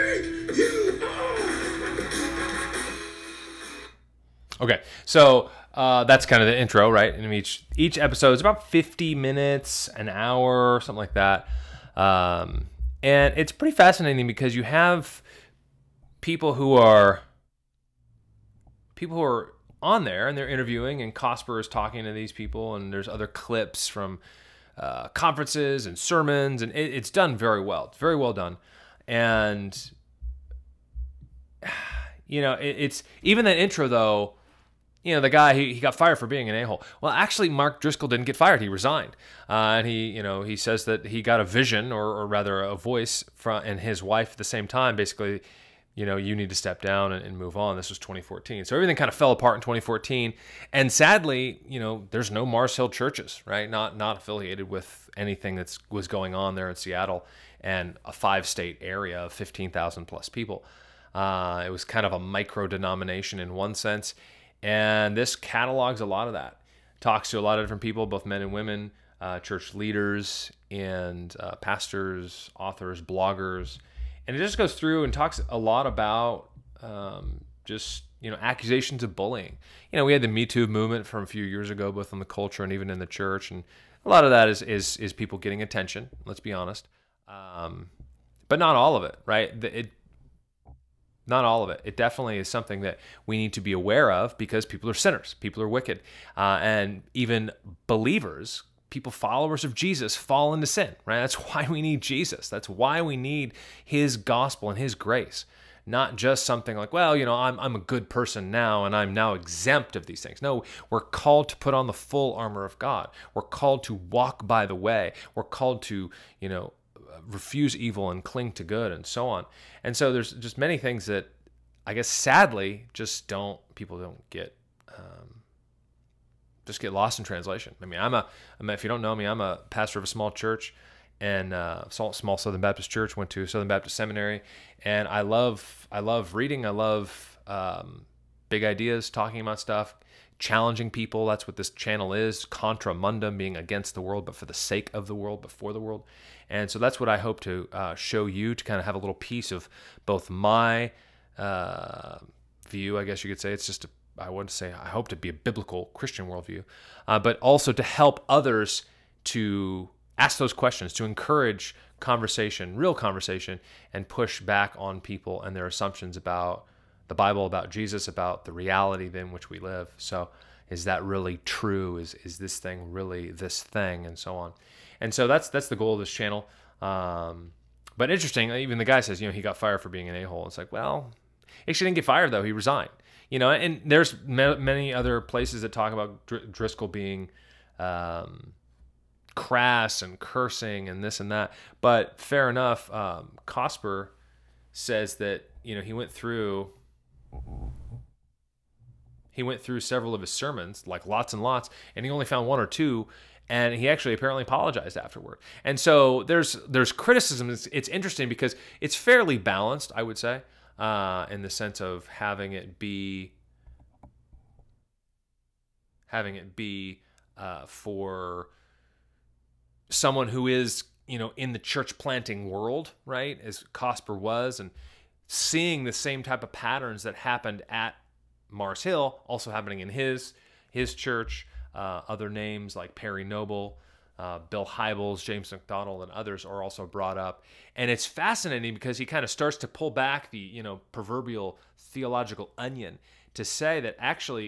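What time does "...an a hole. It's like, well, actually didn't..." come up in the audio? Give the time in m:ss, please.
3:00.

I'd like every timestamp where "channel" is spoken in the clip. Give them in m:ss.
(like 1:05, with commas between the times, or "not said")
2:21, 2:56.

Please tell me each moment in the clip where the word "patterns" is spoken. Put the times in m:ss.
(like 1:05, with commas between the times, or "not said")
3:46.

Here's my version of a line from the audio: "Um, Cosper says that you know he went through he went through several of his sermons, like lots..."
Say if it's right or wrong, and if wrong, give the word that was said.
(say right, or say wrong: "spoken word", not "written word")
right.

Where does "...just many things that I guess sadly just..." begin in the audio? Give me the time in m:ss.
2:00.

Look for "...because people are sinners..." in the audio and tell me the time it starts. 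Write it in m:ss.
1:34.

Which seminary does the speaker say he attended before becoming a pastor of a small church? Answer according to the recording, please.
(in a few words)
Southern Baptist Seminary.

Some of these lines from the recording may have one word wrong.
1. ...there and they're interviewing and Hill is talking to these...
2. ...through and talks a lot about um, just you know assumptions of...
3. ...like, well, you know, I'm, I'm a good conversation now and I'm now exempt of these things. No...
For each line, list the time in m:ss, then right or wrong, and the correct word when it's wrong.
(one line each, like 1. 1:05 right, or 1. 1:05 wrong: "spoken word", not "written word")
1. 0:20 wrong: "Cosper", not "Hill"
2. 1:14 wrong: "accusations", not "assumptions"
3. 1:46 wrong: "person", not "conversation".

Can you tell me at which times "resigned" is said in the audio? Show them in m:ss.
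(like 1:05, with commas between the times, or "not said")
0:38, 3:02.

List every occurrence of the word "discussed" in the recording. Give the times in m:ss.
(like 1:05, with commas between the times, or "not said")
not said.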